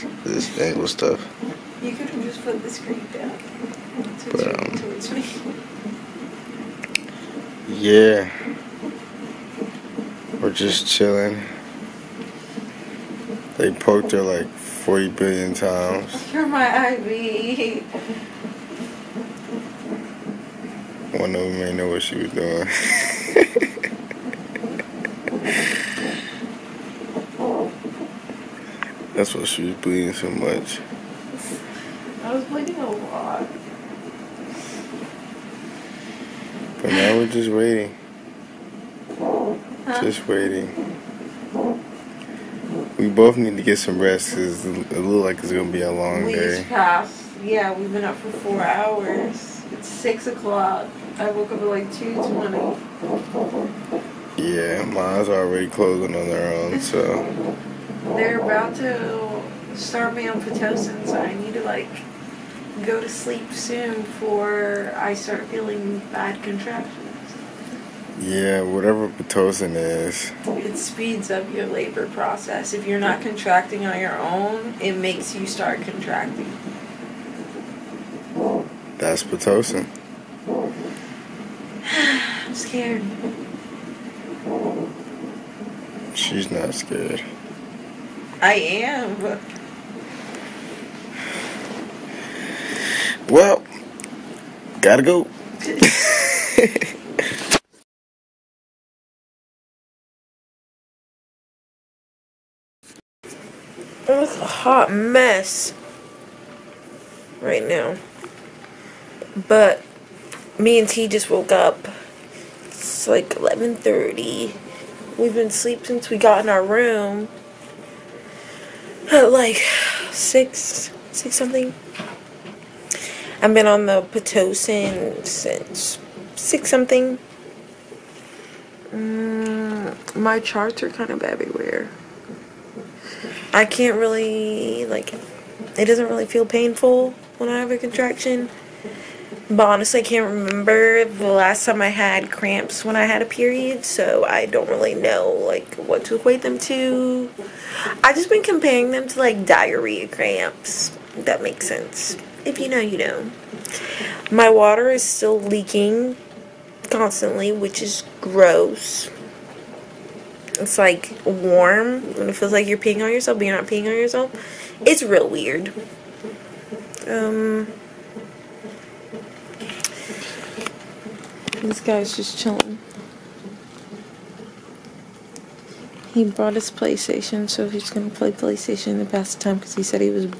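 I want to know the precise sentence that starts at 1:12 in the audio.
If you're not contracting on your own, it makes you start contracting.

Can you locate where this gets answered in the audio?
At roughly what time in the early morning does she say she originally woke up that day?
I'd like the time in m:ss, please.
0:51.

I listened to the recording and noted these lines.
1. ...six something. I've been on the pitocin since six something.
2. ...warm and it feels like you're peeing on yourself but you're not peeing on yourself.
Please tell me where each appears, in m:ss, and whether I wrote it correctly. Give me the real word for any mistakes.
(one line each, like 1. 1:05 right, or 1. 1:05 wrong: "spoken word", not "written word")
1. 2:01 right
2. 2:41 right.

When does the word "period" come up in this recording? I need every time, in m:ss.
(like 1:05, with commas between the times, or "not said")
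2:23.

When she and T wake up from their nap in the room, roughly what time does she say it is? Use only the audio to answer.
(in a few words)
11:30.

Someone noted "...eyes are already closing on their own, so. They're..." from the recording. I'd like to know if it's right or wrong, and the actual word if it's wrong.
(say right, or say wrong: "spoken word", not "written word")
right.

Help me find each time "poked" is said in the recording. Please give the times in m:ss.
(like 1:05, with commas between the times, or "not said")
0:13.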